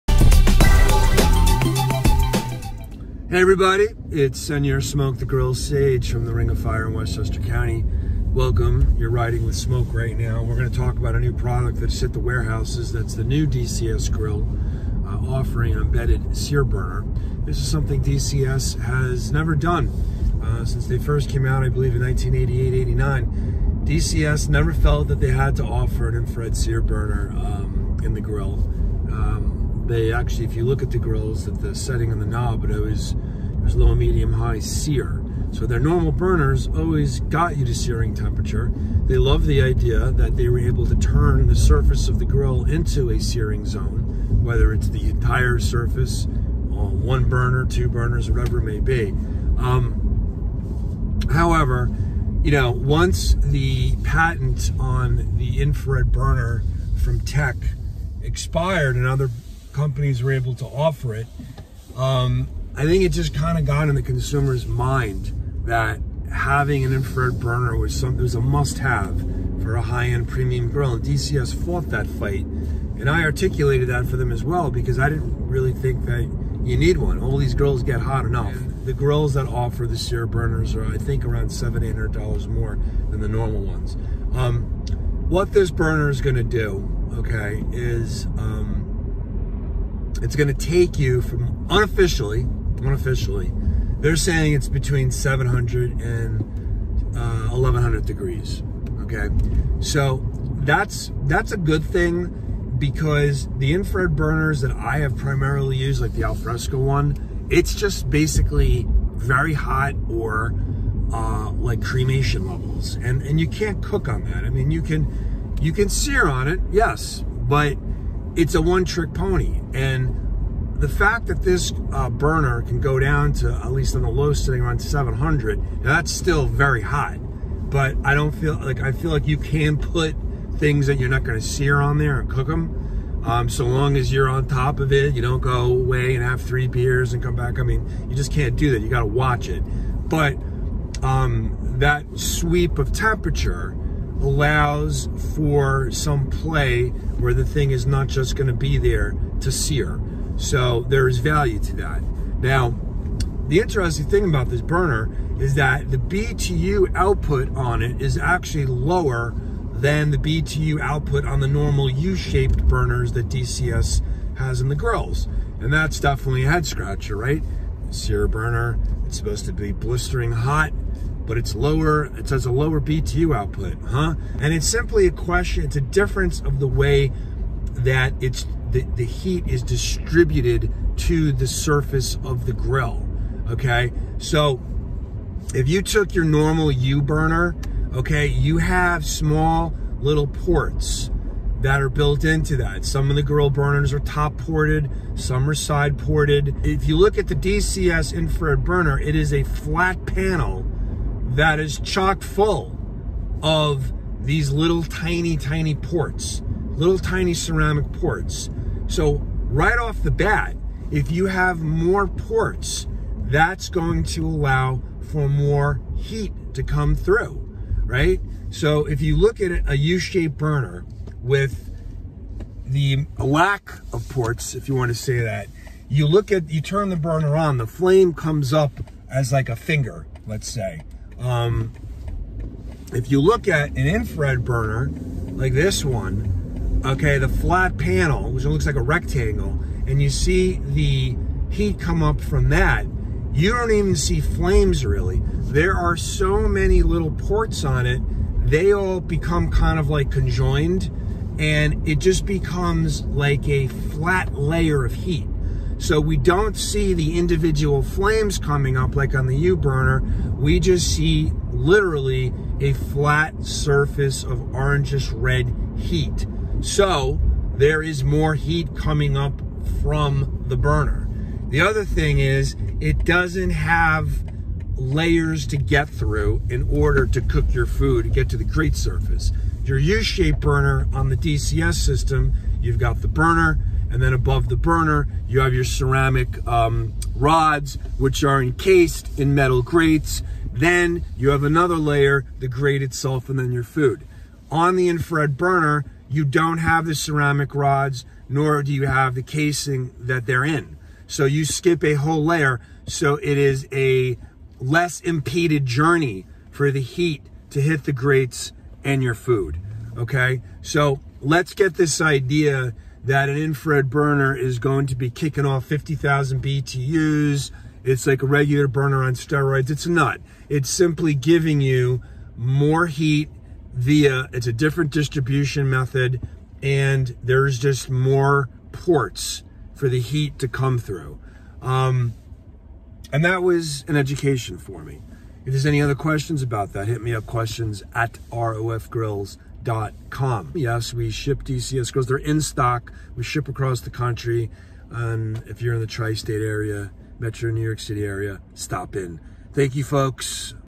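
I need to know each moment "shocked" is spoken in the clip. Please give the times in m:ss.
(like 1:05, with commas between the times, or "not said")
not said.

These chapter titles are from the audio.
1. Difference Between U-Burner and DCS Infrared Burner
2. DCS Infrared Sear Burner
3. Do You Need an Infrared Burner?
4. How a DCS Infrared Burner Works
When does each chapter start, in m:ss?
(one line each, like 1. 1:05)
1. 3:00
2. 0:15
3. 1:00
4. 1:20.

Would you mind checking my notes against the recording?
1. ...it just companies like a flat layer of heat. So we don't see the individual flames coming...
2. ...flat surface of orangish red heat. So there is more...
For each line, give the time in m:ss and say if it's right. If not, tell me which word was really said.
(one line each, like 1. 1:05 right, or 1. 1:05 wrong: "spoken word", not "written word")
1. 4:11 wrong: "becomes", not "companies"
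2. 4:22 right.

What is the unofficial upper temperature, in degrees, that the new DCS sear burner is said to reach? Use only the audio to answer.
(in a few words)
1100.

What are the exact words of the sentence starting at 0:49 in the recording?
Um, however, you know, once the patent on the infrared burner from Tech expired and other companies were able to offer it.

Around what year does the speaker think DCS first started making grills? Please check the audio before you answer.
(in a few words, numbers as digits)
1988.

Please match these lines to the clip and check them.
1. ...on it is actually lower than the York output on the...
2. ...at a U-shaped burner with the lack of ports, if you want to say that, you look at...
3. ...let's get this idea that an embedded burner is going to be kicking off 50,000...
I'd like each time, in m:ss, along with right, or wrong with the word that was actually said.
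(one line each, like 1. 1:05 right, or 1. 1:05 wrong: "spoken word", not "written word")
1. 2:37 wrong: "BTU", not "York"
2. 3:39 right
3. 5:11 wrong: "infrared", not "embedded".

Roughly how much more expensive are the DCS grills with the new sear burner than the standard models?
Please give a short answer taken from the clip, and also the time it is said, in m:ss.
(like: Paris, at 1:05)
$700-800, at 1:21.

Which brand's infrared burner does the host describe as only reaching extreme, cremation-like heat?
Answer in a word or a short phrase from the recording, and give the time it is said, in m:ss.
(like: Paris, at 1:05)
Alfresco, at 1:46.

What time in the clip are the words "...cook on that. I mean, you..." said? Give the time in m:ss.
1:53.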